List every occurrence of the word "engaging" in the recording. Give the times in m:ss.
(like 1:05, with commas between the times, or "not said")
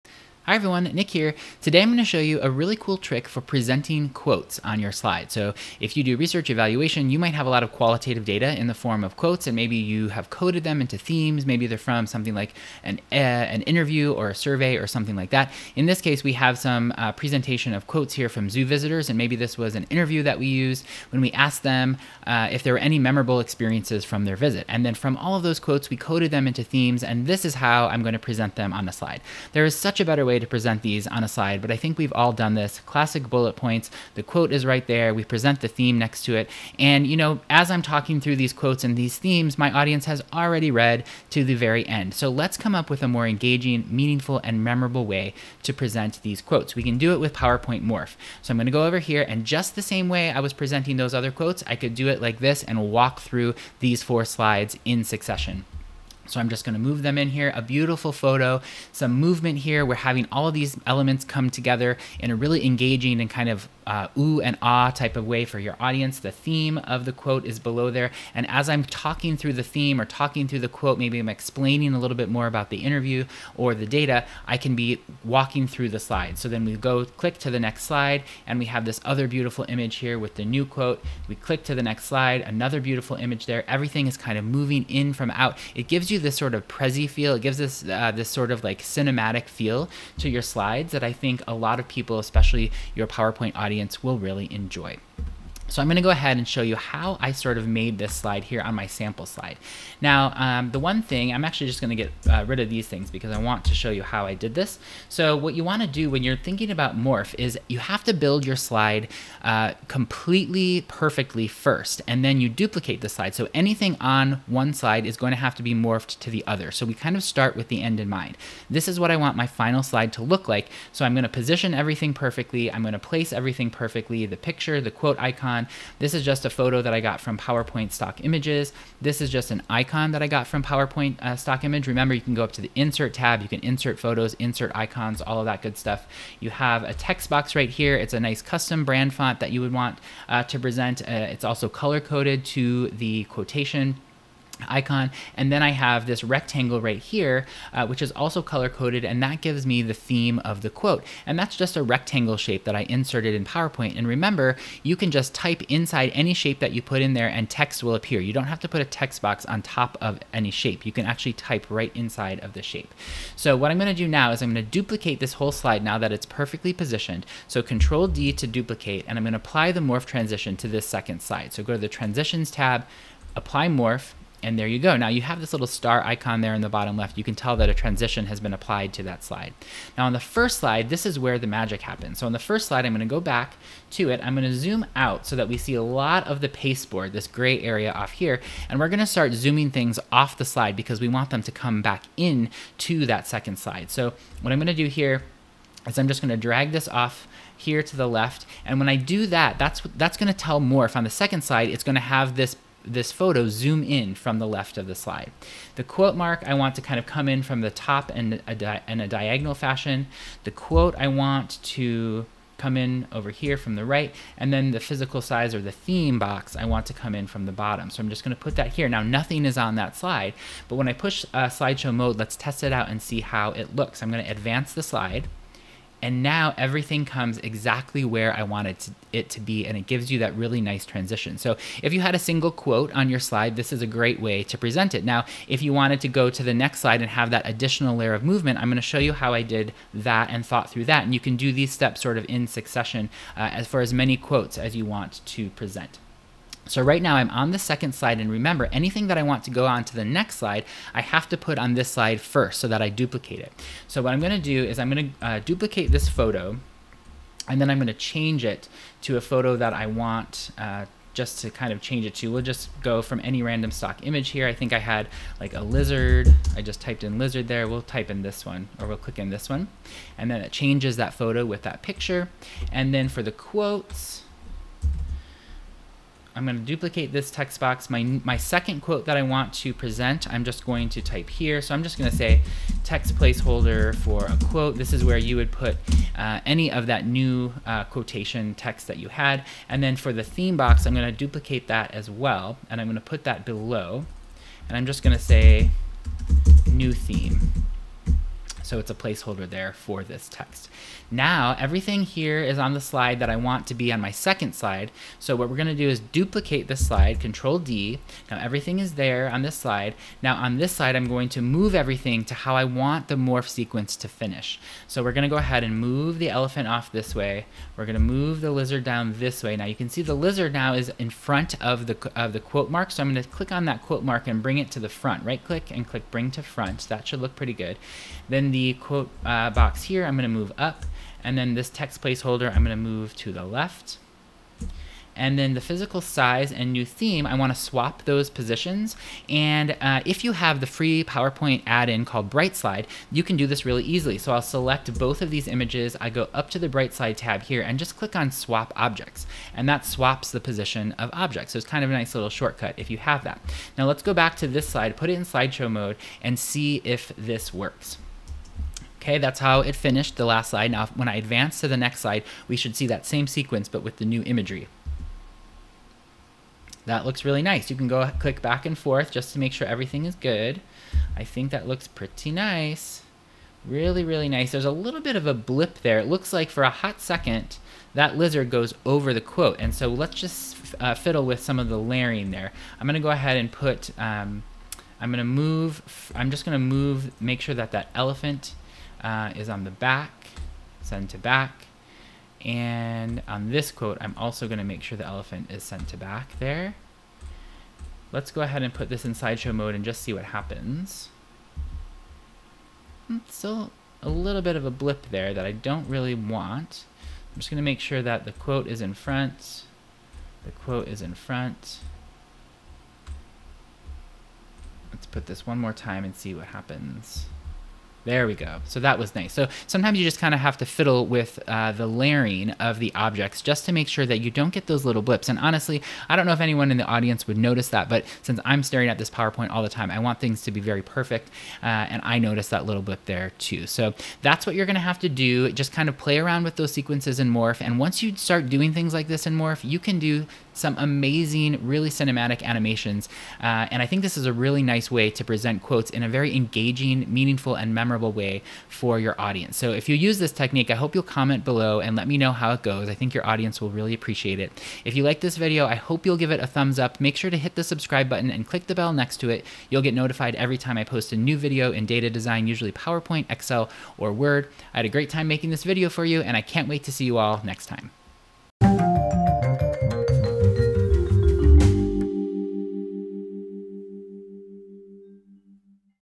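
0:43, 1:02, 7:26.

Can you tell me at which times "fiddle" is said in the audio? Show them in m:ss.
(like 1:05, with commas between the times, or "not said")
6:20, 7:00.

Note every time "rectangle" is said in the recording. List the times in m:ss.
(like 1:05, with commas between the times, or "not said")
2:26, 2:31.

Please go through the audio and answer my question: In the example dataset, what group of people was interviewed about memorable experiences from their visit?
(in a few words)
Zoo visitors.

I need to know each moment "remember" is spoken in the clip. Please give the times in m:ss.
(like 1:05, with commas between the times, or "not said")
2:11, 2:34, 4:08.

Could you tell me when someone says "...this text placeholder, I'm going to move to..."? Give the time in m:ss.
5:31.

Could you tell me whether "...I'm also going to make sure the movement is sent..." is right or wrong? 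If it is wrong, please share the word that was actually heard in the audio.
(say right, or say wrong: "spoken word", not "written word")
wrong: "elephant", not "movement".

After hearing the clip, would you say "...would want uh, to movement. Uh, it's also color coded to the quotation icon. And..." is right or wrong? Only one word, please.
wrong.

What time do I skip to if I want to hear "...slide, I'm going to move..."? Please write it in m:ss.
5:10.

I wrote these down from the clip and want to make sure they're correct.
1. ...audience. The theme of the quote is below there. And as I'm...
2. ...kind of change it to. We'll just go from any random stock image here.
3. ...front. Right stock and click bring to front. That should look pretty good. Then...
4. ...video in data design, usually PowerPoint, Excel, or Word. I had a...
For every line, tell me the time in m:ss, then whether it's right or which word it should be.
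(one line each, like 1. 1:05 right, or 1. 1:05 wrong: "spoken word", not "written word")
1. 1:05 right
2. 4:21 right
3. 5:24 wrong: "click", not "stock"
4. 7:41 right.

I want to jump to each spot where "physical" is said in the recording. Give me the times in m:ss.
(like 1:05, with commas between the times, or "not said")
3:34, 5:35.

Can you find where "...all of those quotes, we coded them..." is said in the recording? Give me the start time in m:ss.
0:25.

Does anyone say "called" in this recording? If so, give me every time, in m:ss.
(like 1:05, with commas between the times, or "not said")
5:42.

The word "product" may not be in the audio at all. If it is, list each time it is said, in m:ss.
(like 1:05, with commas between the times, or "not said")
not said.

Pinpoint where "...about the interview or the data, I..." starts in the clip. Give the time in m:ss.
1:12.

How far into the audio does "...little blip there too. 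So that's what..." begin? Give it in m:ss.
7:12.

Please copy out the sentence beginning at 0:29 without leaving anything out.
There is such a better way to present these on a slide, but I think we've all done this.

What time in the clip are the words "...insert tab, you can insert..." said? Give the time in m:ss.
2:12.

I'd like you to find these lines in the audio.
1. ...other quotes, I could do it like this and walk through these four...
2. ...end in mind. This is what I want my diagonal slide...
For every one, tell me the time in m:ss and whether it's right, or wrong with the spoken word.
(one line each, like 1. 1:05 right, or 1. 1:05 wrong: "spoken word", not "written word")
1. 0:51 right
2. 1:57 wrong: "final", not "diagonal".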